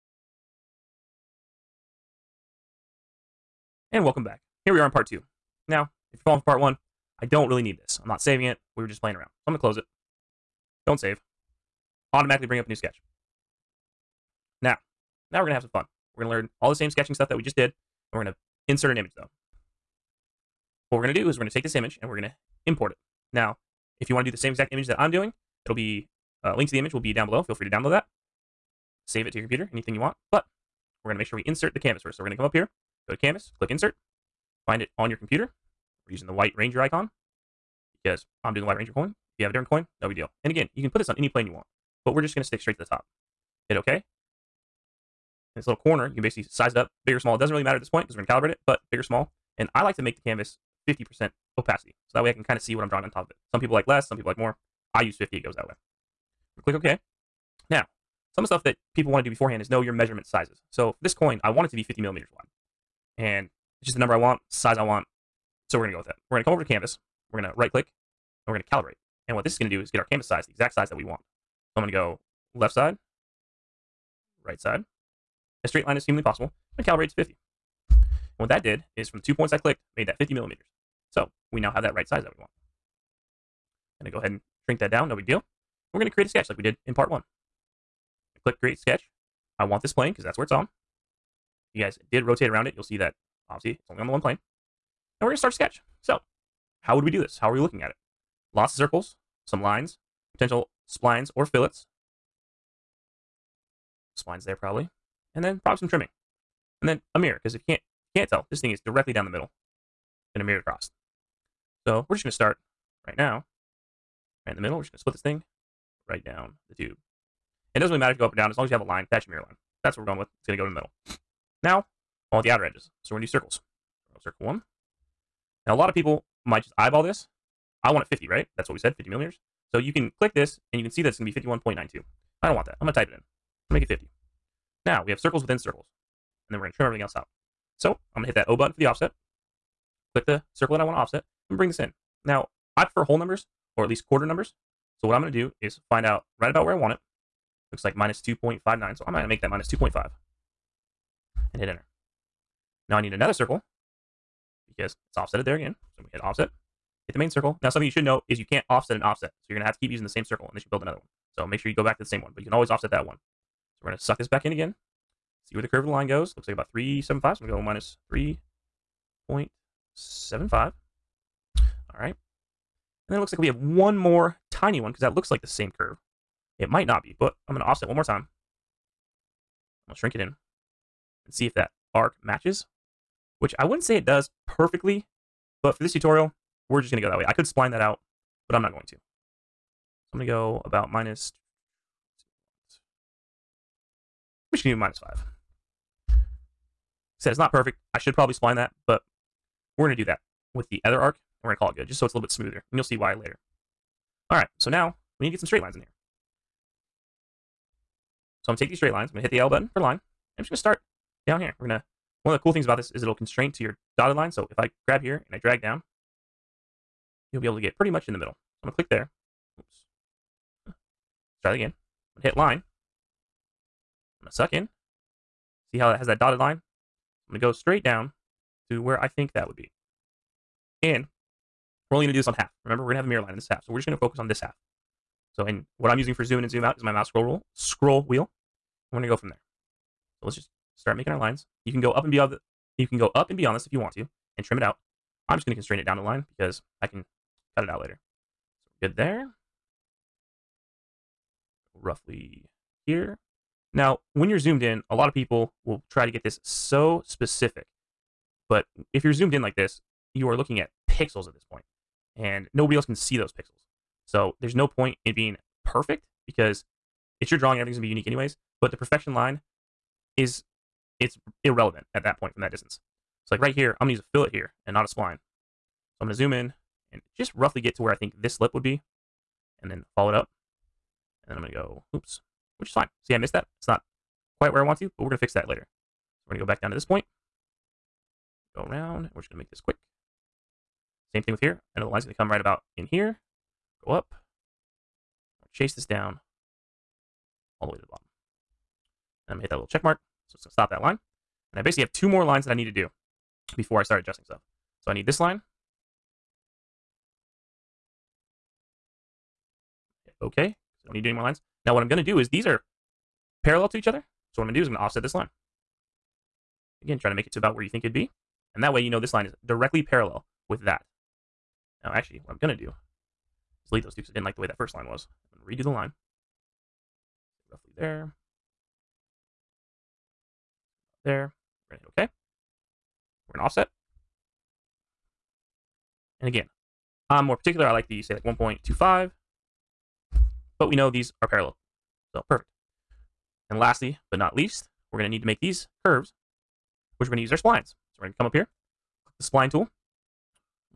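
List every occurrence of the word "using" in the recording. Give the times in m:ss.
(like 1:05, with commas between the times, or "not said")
0:36, 2:39, 3:55.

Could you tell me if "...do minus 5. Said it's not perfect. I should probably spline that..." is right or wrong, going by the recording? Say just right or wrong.
right.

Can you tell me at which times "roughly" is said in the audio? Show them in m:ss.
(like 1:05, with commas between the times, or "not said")
4:11, 4:37, 5:27.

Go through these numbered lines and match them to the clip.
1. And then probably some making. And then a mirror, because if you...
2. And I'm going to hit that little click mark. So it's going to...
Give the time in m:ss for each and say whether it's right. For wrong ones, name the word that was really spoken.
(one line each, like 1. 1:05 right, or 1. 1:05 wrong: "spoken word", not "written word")
1. 1:45 wrong: "trimming", not "making"
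2. 4:59 wrong: "check", not "click".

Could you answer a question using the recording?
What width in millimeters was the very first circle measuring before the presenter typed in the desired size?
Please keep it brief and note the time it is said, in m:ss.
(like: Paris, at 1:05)
51.92, at 2:11.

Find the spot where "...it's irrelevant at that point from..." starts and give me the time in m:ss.
4:30.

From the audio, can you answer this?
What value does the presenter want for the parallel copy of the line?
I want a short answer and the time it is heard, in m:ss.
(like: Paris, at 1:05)
1.25, at 5:38.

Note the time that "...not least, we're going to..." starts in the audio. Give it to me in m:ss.
5:44.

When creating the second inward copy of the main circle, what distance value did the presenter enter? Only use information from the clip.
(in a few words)
-3.75.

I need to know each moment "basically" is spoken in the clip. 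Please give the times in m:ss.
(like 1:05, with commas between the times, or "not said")
0:46, 5:01.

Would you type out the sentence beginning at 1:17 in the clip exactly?
And what that did is from the two points I clicked, made that 50 millimeters.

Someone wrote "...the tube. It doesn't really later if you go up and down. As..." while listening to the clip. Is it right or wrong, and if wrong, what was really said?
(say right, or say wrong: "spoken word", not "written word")
wrong: "matter", not "later".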